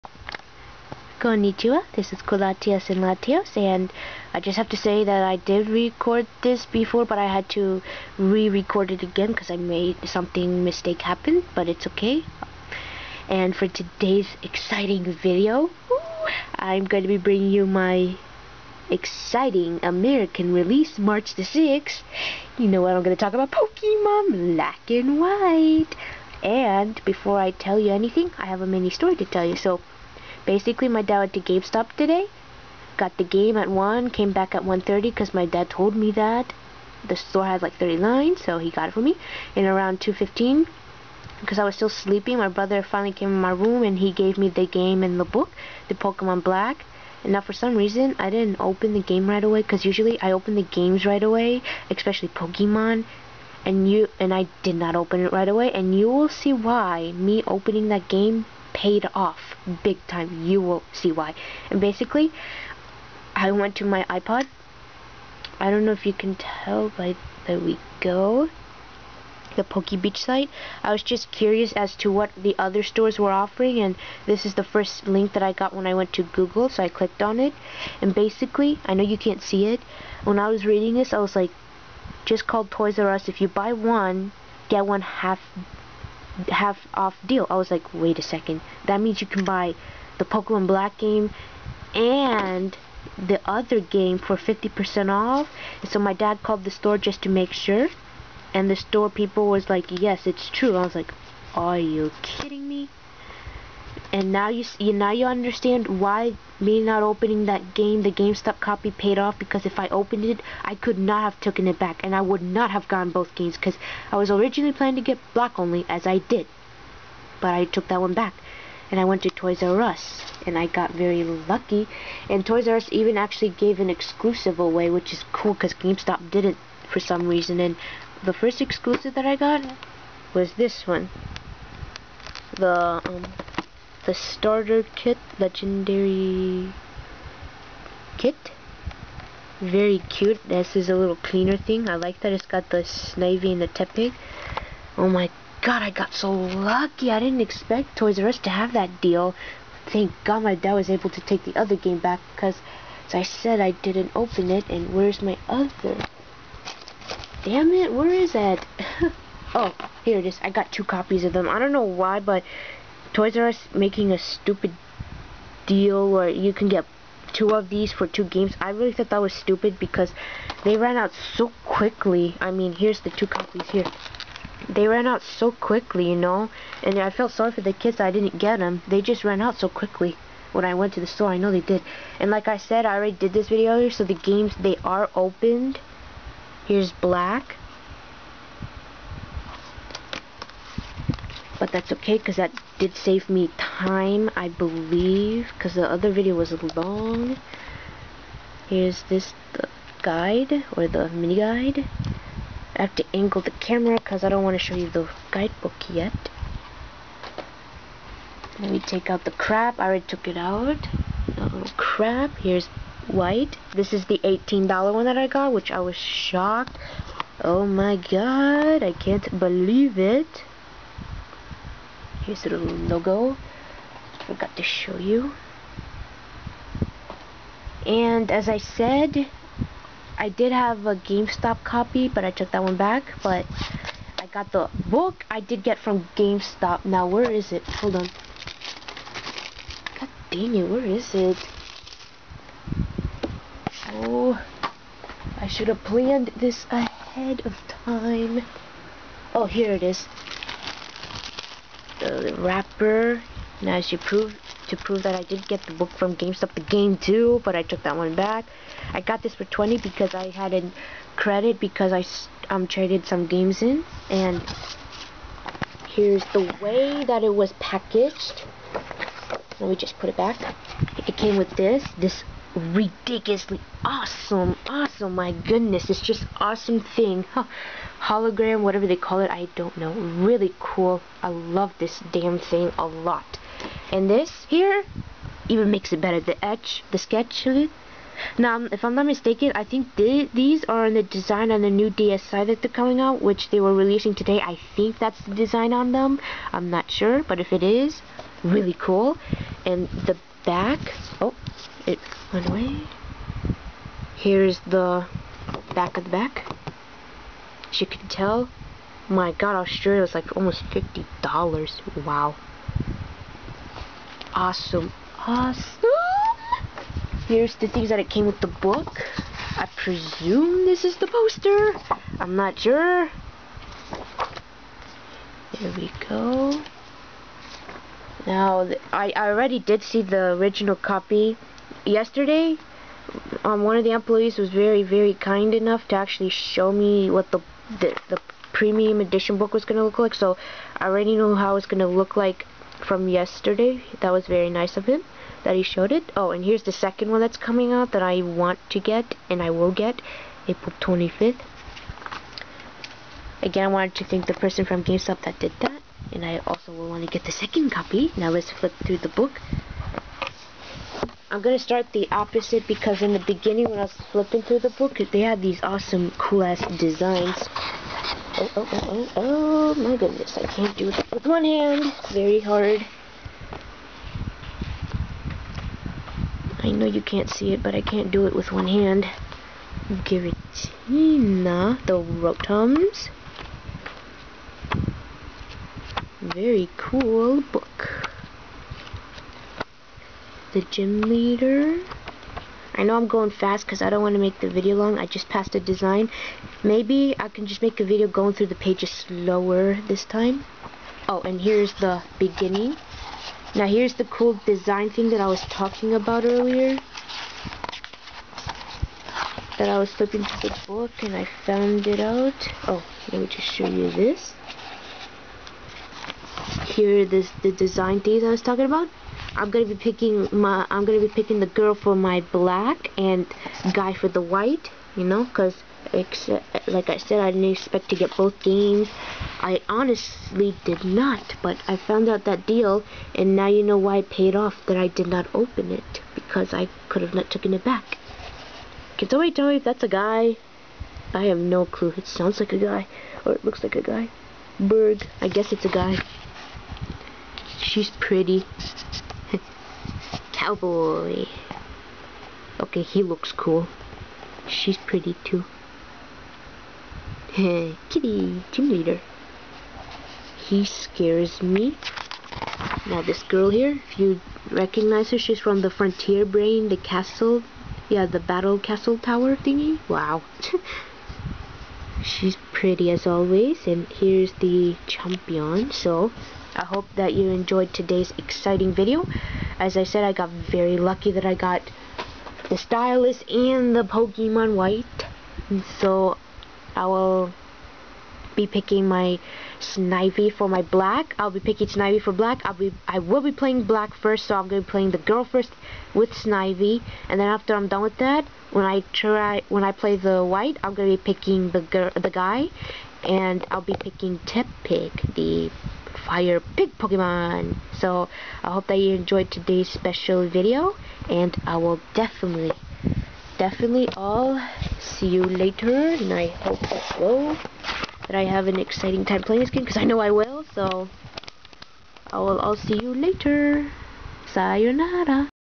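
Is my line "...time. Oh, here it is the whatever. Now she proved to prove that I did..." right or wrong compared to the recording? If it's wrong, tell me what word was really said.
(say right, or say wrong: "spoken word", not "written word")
wrong: "wrapper", not "whatever".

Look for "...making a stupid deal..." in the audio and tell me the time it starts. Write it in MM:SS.
02:43.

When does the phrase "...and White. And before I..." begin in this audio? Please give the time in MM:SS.
00:24.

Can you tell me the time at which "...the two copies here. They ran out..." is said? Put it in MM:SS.
02:53.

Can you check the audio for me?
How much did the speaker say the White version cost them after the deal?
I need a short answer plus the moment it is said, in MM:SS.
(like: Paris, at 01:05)
$18, at 03:34.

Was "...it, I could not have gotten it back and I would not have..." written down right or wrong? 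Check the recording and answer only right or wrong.
wrong.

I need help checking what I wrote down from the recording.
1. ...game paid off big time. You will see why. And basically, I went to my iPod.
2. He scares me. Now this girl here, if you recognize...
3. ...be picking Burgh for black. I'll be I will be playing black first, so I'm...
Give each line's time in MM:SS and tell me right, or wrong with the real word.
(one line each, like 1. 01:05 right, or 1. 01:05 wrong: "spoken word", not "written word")
1. 00:58 right
2. 07:40 right
3. 08:11 wrong: "Snivy", not "Burgh".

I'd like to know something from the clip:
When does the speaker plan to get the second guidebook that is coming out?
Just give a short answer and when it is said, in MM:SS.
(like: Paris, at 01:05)
April 25th, at 05:50.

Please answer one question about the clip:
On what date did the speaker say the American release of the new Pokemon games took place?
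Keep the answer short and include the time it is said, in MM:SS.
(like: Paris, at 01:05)
March 6th, at 00:20.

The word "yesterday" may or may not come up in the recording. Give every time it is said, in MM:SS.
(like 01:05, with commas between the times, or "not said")
05:31, 05:43.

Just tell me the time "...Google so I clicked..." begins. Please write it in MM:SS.
01:16.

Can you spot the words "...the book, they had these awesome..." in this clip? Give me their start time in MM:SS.
06:04.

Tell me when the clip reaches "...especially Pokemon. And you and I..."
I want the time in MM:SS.
00:51.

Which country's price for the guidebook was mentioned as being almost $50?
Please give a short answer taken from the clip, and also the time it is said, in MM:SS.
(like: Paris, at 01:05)
Australia, at 05:09.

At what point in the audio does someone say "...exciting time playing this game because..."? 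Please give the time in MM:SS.
08:38.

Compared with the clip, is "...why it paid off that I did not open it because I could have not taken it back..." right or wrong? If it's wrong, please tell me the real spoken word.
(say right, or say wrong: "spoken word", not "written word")
right.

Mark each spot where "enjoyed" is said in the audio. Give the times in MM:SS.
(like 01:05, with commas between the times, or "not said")
07:57, 08:28.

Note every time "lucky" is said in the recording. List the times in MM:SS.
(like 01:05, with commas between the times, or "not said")
02:01, 02:26, 08:00.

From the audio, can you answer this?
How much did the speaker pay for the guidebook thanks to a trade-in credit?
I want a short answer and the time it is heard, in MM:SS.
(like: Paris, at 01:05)
20, at 04:19.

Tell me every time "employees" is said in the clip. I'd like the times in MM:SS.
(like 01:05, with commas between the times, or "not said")
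05:33.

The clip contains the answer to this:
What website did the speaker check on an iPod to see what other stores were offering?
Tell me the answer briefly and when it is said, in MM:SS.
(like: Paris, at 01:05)
Poke Beach, at 01:09.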